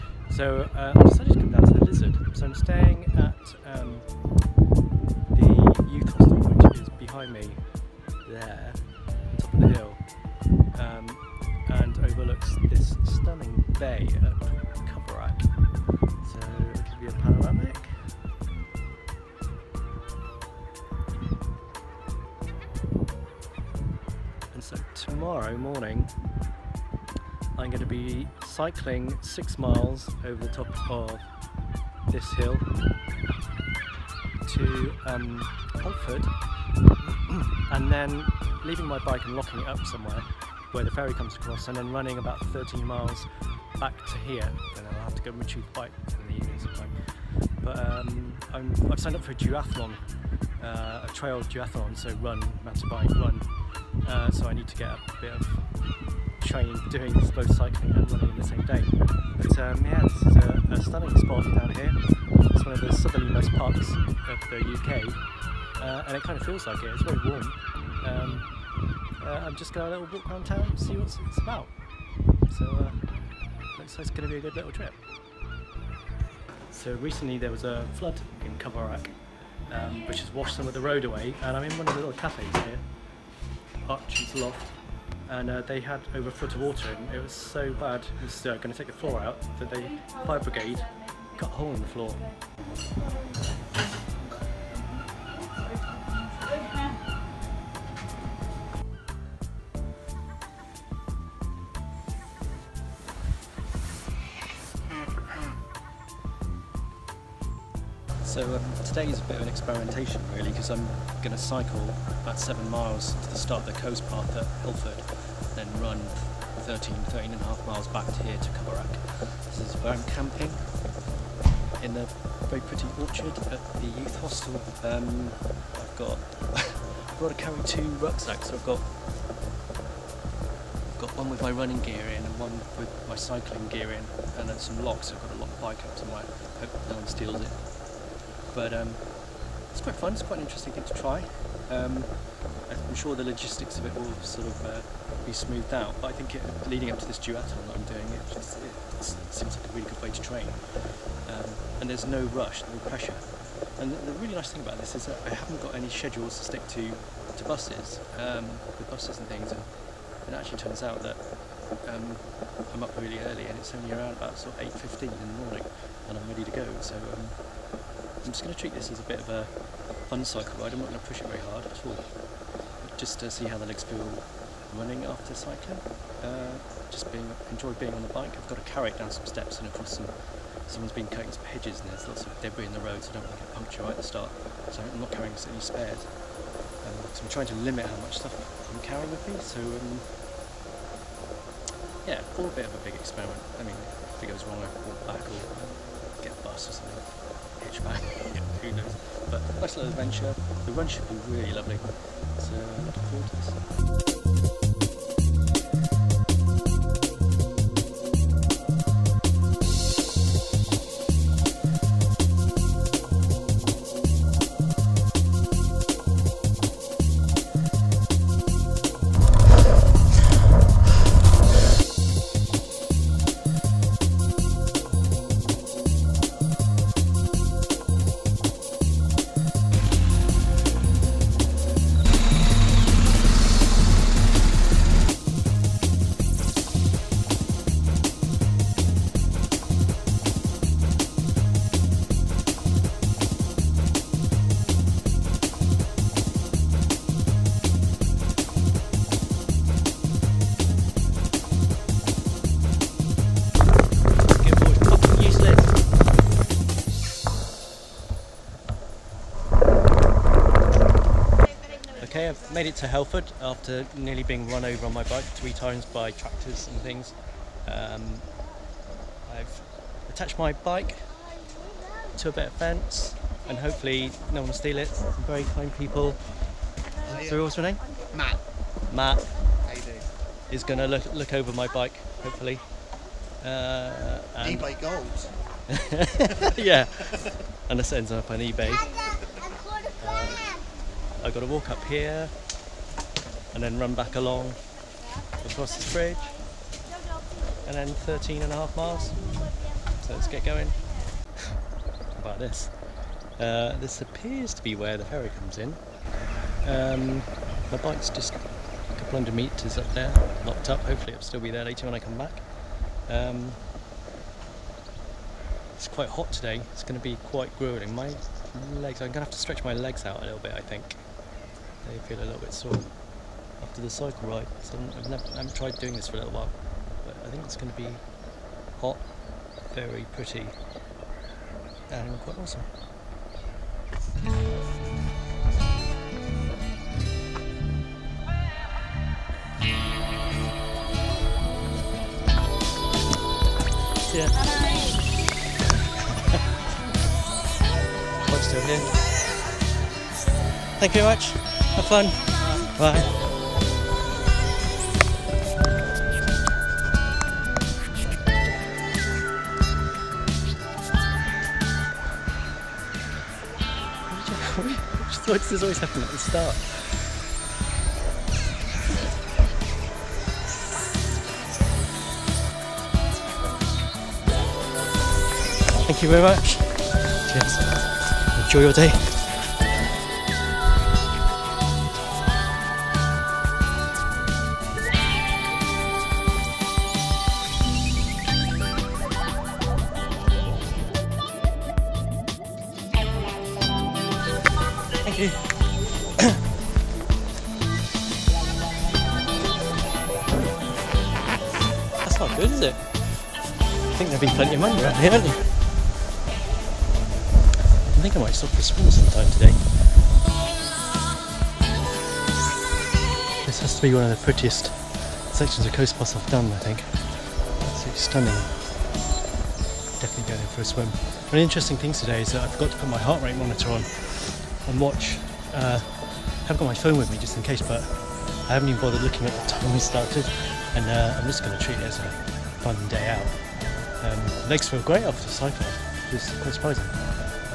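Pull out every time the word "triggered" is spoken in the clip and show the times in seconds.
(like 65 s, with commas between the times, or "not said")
not said.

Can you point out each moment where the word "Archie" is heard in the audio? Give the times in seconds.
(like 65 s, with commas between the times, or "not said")
83 s.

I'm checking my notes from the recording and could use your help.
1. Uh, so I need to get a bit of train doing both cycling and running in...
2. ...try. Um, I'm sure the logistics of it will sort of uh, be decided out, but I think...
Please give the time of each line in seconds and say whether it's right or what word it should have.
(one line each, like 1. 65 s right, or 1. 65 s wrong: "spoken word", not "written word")
1. 54 s right
2. 140 s wrong: "smoothed", not "decided".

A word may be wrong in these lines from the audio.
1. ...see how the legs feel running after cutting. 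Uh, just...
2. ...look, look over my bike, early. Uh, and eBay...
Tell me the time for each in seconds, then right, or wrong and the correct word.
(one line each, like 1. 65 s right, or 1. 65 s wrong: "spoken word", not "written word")
1. 173 s wrong: "cycling", not "cutting"
2. 280 s wrong: "hopefully", not "early".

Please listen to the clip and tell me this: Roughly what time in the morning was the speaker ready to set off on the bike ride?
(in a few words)
8.15.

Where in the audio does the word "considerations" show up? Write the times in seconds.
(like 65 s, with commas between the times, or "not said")
not said.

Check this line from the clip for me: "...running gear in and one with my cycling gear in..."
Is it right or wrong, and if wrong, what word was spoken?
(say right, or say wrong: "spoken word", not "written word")
right.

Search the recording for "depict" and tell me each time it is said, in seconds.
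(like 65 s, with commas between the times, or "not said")
not said.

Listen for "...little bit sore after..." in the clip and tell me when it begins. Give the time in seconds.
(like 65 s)
322 s.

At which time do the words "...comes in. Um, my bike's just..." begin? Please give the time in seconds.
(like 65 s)
305 s.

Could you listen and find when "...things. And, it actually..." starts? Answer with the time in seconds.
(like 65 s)
159 s.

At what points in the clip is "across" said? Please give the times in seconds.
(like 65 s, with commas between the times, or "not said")
41 s, 179 s, 295 s.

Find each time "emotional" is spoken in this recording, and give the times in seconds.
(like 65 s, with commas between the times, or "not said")
not said.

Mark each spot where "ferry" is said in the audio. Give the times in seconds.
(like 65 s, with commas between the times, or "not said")
40 s, 305 s.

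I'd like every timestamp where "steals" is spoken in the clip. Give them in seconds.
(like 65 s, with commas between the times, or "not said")
137 s, 274 s.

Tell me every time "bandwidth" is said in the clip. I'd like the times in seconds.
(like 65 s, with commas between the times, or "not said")
not said.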